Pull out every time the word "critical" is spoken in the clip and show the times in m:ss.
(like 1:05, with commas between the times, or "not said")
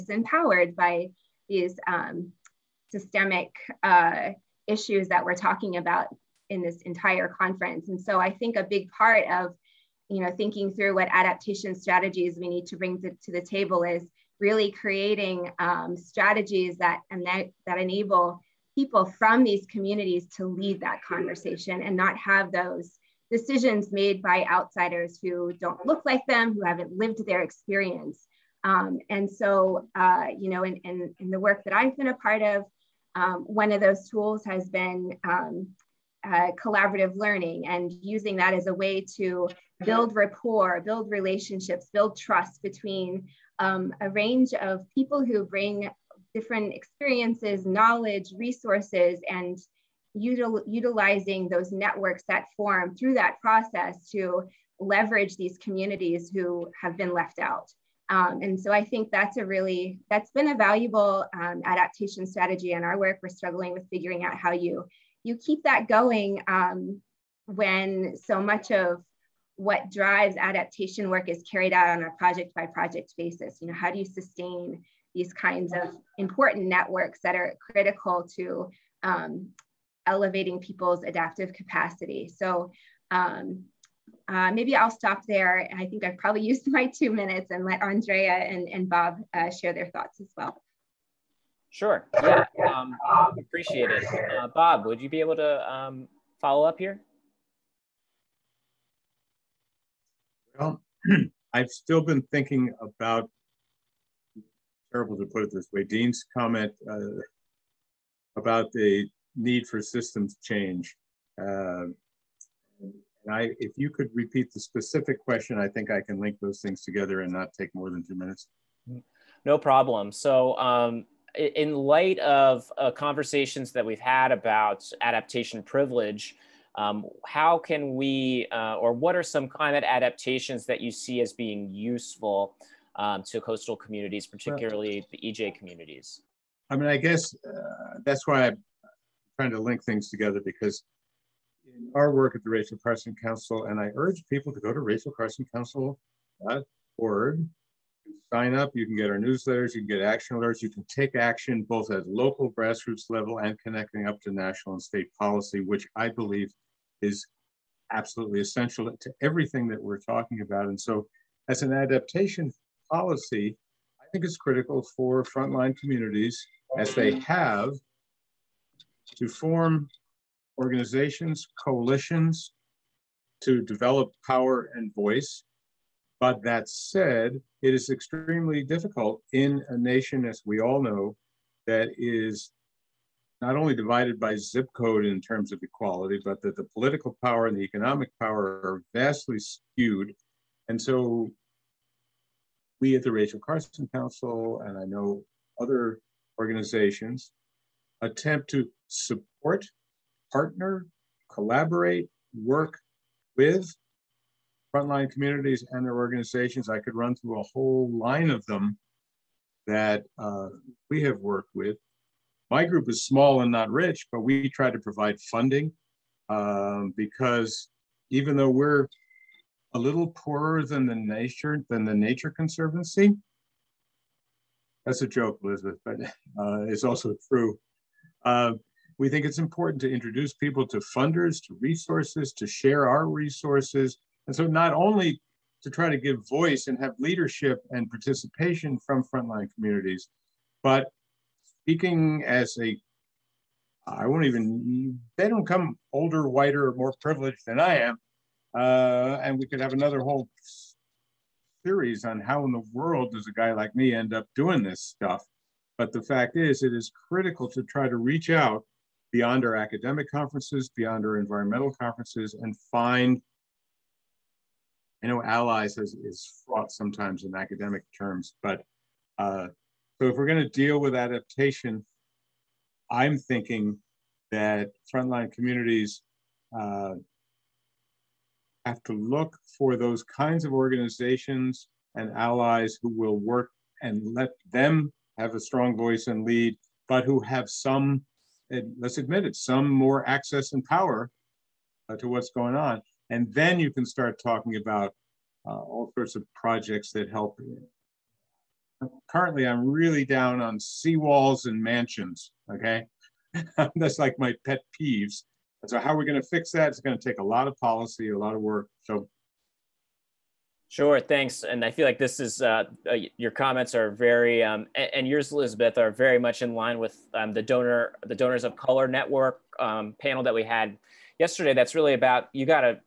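1:17, 2:44, 4:17.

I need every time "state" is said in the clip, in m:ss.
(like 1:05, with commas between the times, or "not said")
2:34.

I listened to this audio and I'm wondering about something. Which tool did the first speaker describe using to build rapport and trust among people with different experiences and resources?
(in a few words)
Collaborative learning.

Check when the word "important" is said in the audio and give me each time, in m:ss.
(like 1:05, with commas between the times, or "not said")
1:16, 3:49.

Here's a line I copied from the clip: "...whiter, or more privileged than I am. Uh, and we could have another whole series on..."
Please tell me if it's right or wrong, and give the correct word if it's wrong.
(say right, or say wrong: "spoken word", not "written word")
right.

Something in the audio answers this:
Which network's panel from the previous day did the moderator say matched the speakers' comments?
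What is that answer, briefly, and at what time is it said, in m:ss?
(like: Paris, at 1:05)
Donors of Color Network, at 5:18.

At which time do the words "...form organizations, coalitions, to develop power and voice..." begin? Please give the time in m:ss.
2:49.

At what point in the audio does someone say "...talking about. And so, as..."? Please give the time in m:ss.
2:39.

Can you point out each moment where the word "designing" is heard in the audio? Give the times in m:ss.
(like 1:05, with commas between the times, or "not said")
not said.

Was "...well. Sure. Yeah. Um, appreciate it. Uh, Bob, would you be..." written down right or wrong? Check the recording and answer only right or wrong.
right.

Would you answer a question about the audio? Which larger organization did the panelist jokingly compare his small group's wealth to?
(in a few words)
The Nature Conservancy.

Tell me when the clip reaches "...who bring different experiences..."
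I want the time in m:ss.
0:45.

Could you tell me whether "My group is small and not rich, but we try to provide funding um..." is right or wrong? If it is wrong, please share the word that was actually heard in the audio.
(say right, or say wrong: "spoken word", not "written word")
right.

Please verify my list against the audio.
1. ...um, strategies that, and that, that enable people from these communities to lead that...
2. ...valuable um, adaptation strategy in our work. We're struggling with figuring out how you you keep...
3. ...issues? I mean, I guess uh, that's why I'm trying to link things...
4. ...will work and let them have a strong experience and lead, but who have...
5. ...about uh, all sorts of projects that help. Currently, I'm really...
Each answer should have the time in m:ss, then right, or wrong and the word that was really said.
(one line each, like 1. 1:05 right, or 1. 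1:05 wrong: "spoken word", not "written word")
1. 0:15 right
2. 1:00 right
3. 2:15 wrong: "communities", not "issues"
4. 4:42 wrong: "voice", not "experience"
5. 4:54 right.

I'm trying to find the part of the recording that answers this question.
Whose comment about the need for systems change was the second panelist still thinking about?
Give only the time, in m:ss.
1:45.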